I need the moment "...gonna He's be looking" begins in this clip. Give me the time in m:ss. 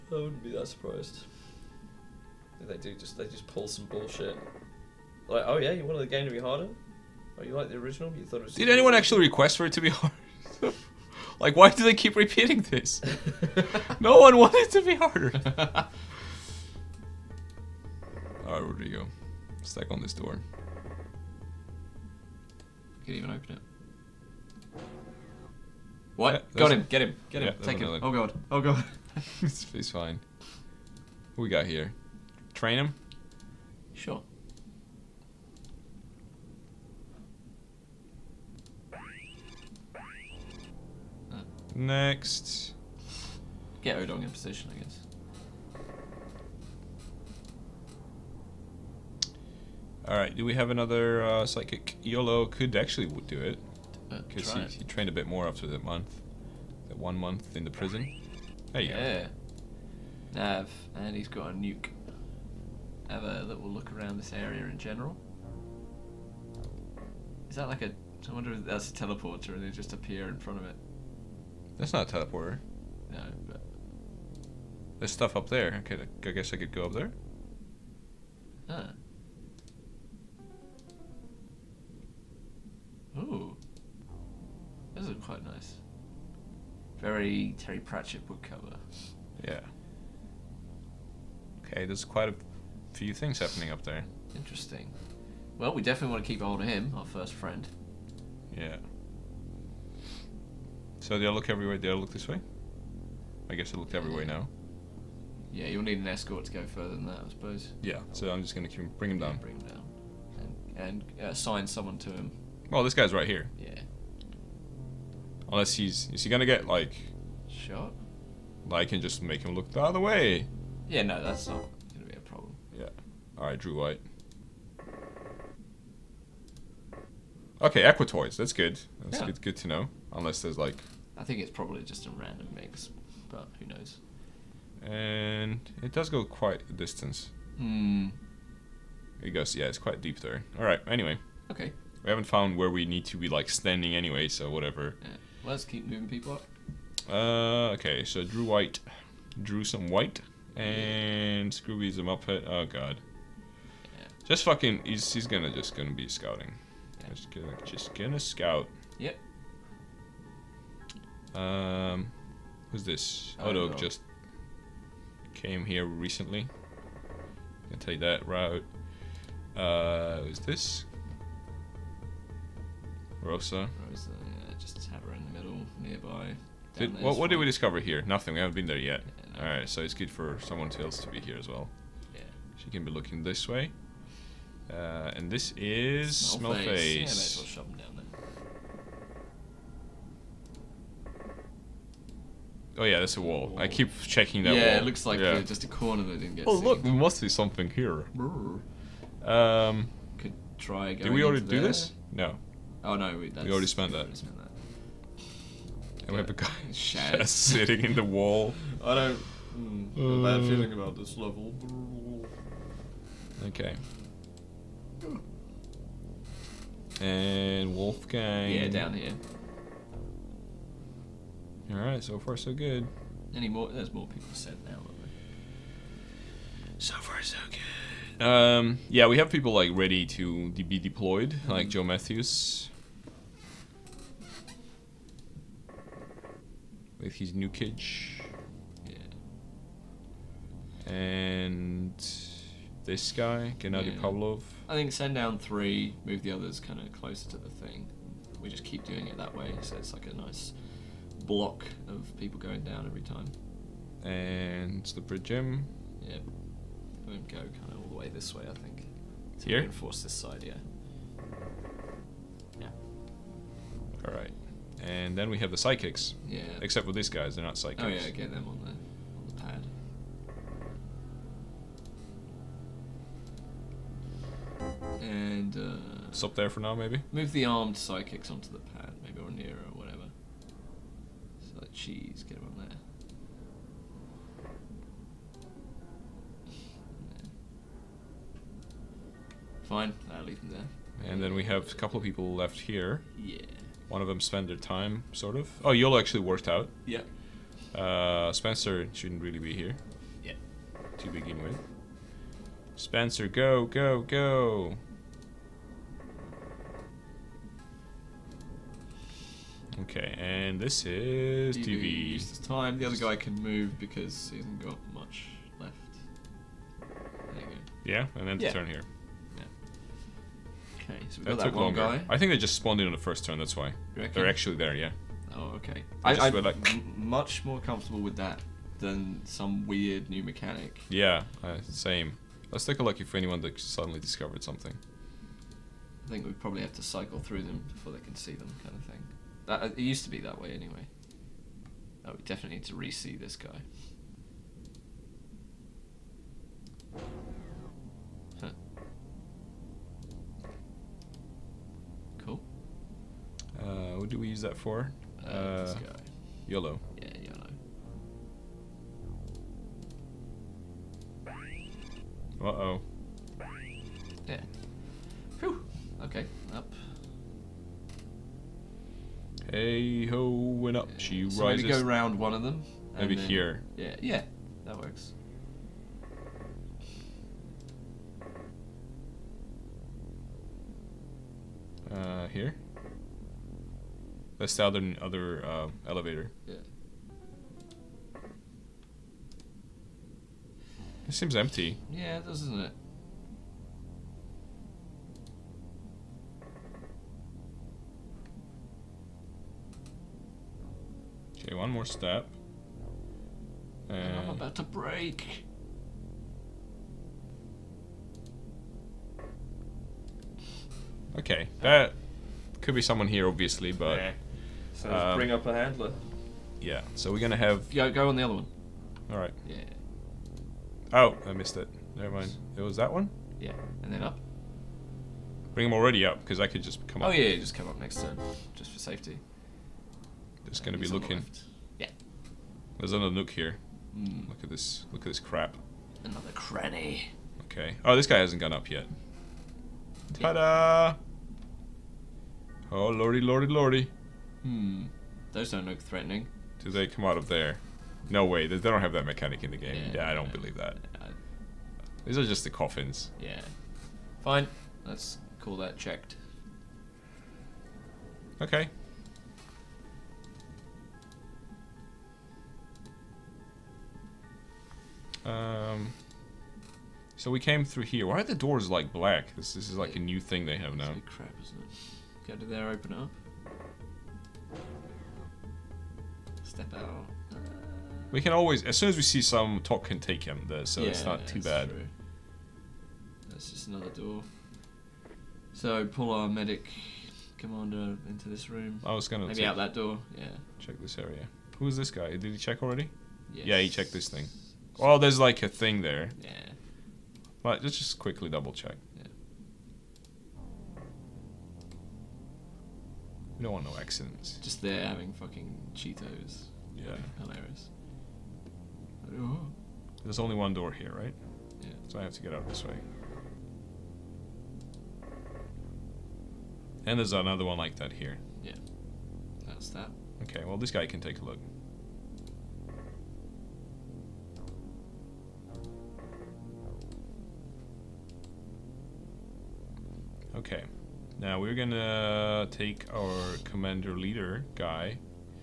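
7:10.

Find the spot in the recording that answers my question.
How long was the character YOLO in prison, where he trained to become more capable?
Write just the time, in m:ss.
0:56.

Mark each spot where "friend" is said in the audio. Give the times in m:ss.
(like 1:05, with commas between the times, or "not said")
1:37.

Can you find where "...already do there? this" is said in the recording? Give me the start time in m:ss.
3:21.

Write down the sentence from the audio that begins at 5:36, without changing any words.
I think we probably have to cycle through them before they can see them, kind of thing.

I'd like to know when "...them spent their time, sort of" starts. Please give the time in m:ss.
4:54.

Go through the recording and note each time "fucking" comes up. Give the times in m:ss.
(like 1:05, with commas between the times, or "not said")
2:34, 8:25.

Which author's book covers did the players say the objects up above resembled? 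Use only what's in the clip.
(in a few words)
Terry Pratchett.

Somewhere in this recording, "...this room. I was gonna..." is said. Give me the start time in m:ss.
8:08.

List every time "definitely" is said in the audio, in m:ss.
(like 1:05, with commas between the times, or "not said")
1:35, 5:42.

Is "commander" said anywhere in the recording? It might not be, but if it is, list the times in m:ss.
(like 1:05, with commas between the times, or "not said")
8:07, 8:53.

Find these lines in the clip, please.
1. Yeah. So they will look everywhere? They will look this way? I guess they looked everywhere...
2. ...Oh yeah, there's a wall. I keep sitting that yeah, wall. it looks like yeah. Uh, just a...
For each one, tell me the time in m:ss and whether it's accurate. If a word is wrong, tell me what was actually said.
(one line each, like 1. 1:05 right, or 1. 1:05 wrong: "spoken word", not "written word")
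1. 1:38 right
2. 3:12 wrong: "checking", not "sitting".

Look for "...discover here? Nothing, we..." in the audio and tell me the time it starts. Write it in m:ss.
2:57.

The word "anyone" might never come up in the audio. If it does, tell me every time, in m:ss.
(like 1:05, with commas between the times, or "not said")
0:08, 5:33.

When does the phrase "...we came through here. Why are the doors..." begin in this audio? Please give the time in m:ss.
7:47.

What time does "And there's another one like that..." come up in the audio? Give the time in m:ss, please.
8:36.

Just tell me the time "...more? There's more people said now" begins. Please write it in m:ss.
3:43.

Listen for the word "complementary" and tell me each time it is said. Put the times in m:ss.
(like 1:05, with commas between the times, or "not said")
not said.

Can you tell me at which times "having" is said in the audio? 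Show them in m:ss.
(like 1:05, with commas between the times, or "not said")
8:24.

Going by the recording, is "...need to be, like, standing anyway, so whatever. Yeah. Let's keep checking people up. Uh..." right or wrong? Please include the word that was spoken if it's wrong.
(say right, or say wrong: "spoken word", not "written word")
wrong: "moving", not "checking".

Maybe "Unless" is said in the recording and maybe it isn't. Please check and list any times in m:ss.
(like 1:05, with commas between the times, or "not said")
1:55, 2:10.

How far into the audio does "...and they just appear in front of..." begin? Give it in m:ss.
1:09.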